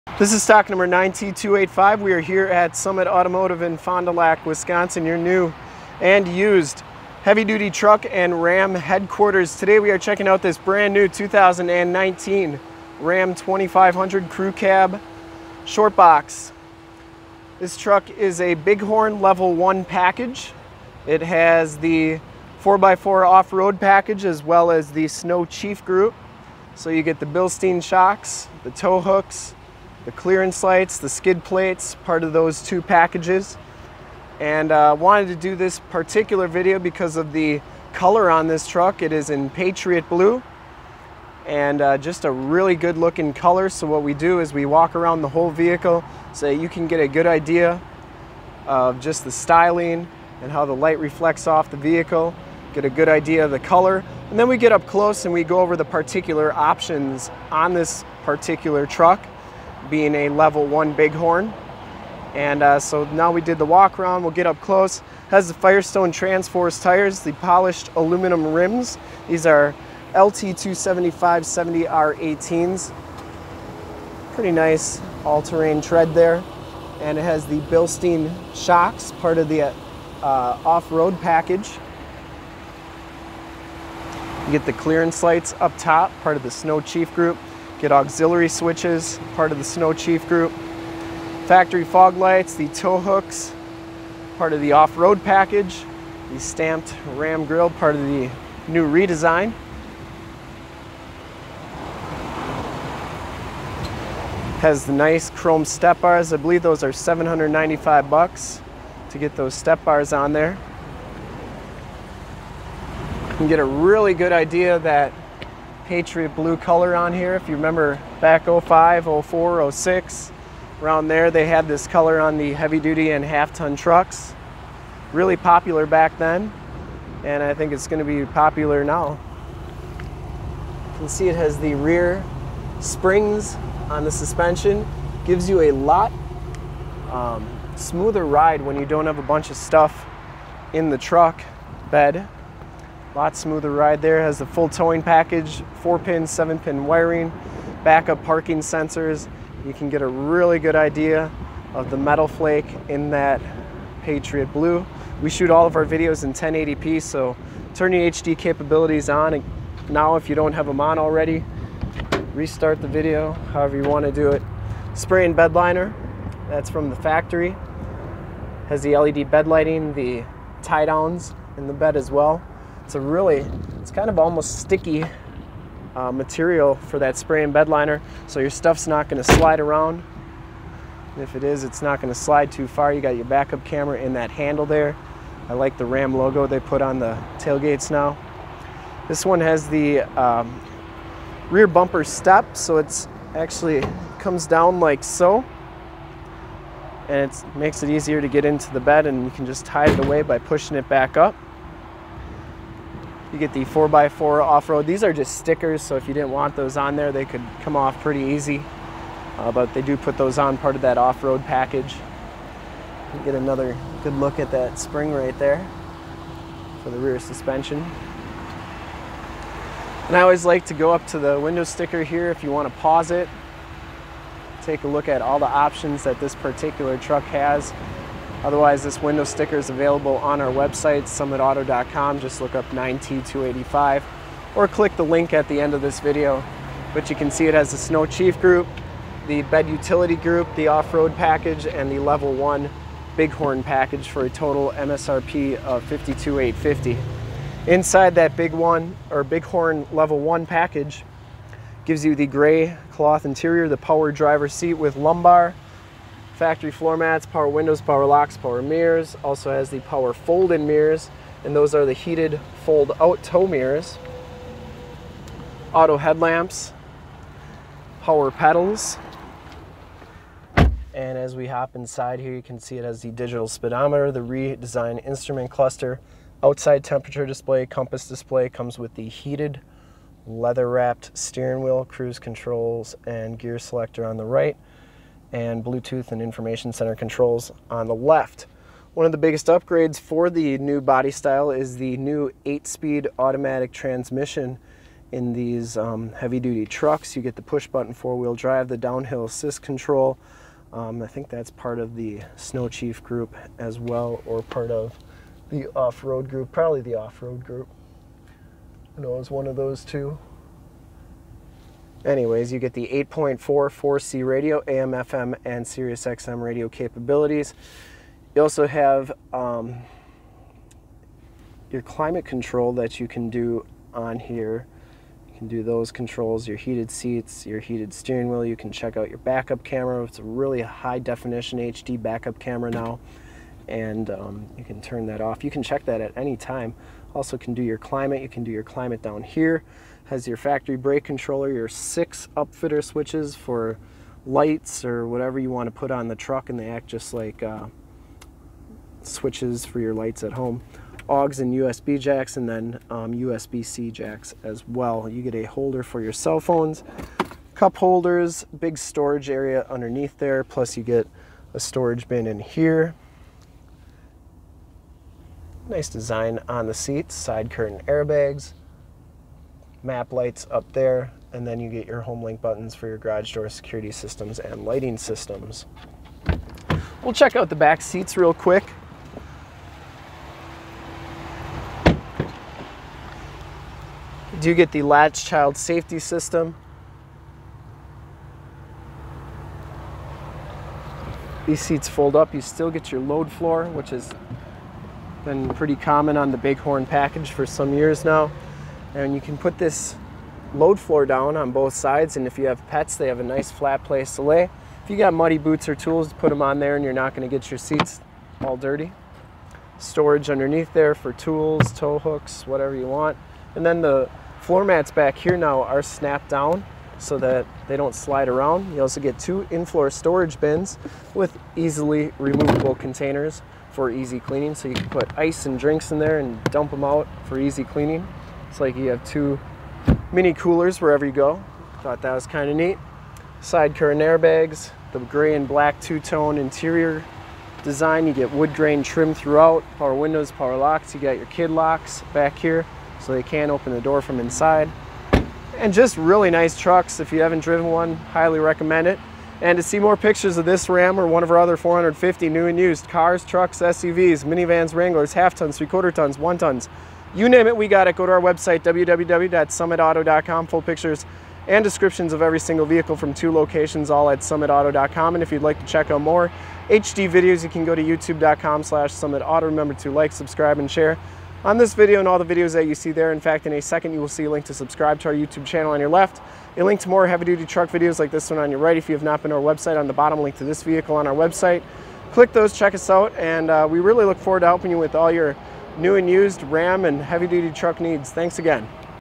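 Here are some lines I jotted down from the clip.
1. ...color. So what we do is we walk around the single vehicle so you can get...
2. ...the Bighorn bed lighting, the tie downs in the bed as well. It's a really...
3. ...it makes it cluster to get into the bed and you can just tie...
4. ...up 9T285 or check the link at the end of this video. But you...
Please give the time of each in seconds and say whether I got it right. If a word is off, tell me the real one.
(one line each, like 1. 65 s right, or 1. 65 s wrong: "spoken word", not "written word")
1. 43 s wrong: "whole", not "single"
2. 168 s wrong: "LED", not "Bighorn"
3. 197 s wrong: "easier", not "cluster"
4. 232 s wrong: "click", not "check".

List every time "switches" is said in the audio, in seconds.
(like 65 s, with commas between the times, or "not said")
88 s, 342 s, 349 s.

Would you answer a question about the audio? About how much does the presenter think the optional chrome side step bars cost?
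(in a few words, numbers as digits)
$795.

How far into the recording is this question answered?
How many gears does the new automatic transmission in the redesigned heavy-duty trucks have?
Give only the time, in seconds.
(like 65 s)
292 s.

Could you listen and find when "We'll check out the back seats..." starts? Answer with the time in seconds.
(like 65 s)
377 s.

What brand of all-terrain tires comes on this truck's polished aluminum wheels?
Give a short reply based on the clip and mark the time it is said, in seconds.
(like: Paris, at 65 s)
Firestone Transforce, at 65 s.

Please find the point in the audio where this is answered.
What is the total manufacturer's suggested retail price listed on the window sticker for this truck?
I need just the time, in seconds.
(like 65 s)
245 s.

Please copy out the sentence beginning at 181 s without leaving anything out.
And if it is, it's not going to slide too far.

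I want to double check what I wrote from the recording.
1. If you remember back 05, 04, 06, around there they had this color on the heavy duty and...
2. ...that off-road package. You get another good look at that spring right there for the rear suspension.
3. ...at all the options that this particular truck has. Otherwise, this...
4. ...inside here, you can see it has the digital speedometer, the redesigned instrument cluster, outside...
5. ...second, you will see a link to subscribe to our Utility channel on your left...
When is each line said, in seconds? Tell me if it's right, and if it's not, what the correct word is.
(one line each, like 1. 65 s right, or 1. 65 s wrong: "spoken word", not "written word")
1. 117 s right
2. 210 s right
3. 225 s right
4. 271 s right
5. 473 s wrong: "YouTube", not "Utility".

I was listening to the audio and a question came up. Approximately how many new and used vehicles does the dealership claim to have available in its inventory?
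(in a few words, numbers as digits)
450.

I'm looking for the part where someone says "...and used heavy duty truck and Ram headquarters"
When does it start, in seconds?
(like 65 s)
6 s.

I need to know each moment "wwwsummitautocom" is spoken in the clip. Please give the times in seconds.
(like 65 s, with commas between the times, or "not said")
458 s.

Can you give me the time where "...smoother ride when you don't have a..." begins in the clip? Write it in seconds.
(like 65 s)
137 s.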